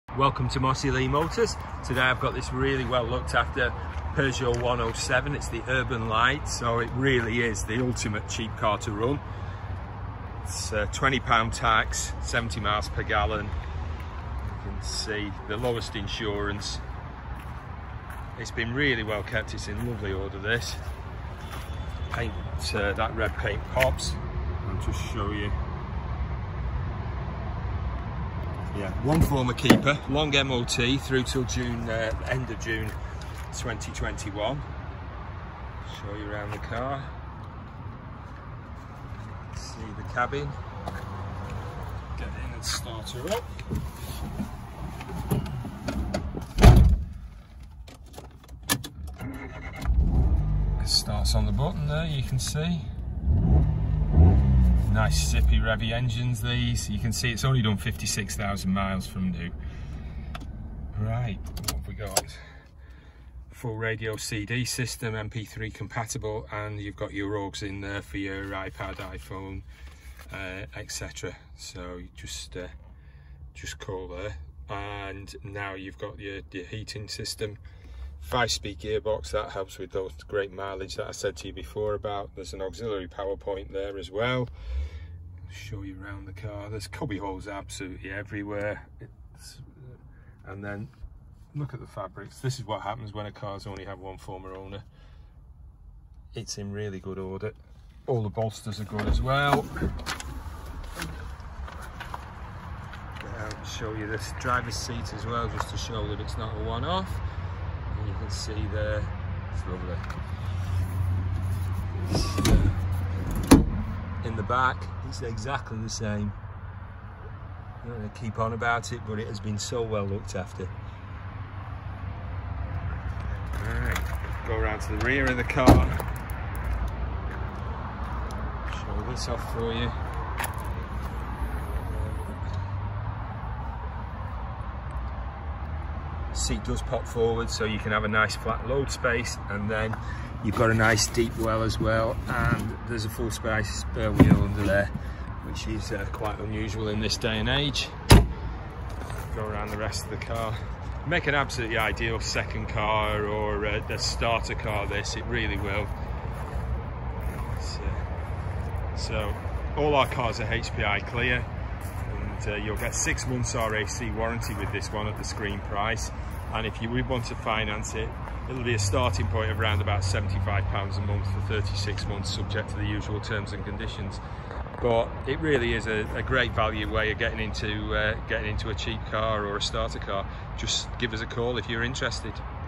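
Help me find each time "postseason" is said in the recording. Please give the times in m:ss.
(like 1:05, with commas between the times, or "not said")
not said.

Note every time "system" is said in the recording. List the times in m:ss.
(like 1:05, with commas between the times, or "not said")
1:04, 1:17.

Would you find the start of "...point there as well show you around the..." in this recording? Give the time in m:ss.
1:23.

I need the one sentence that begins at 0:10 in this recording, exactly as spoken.
It's a uh, 20 pound tax, 70 miles per gallon.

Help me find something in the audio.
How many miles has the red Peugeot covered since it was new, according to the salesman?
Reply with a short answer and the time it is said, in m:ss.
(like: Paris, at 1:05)
56,000, at 0:57.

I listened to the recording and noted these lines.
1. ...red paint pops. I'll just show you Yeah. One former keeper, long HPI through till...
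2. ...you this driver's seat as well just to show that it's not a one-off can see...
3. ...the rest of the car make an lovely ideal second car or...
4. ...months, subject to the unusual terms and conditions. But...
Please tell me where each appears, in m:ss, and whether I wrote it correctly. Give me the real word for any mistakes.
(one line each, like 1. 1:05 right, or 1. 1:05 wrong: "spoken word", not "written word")
1. 0:23 wrong: "MOT", not "HPI"
2. 1:43 right
3. 2:29 wrong: "absolutely", not "lovely"
4. 2:52 wrong: "usual", not "unusual".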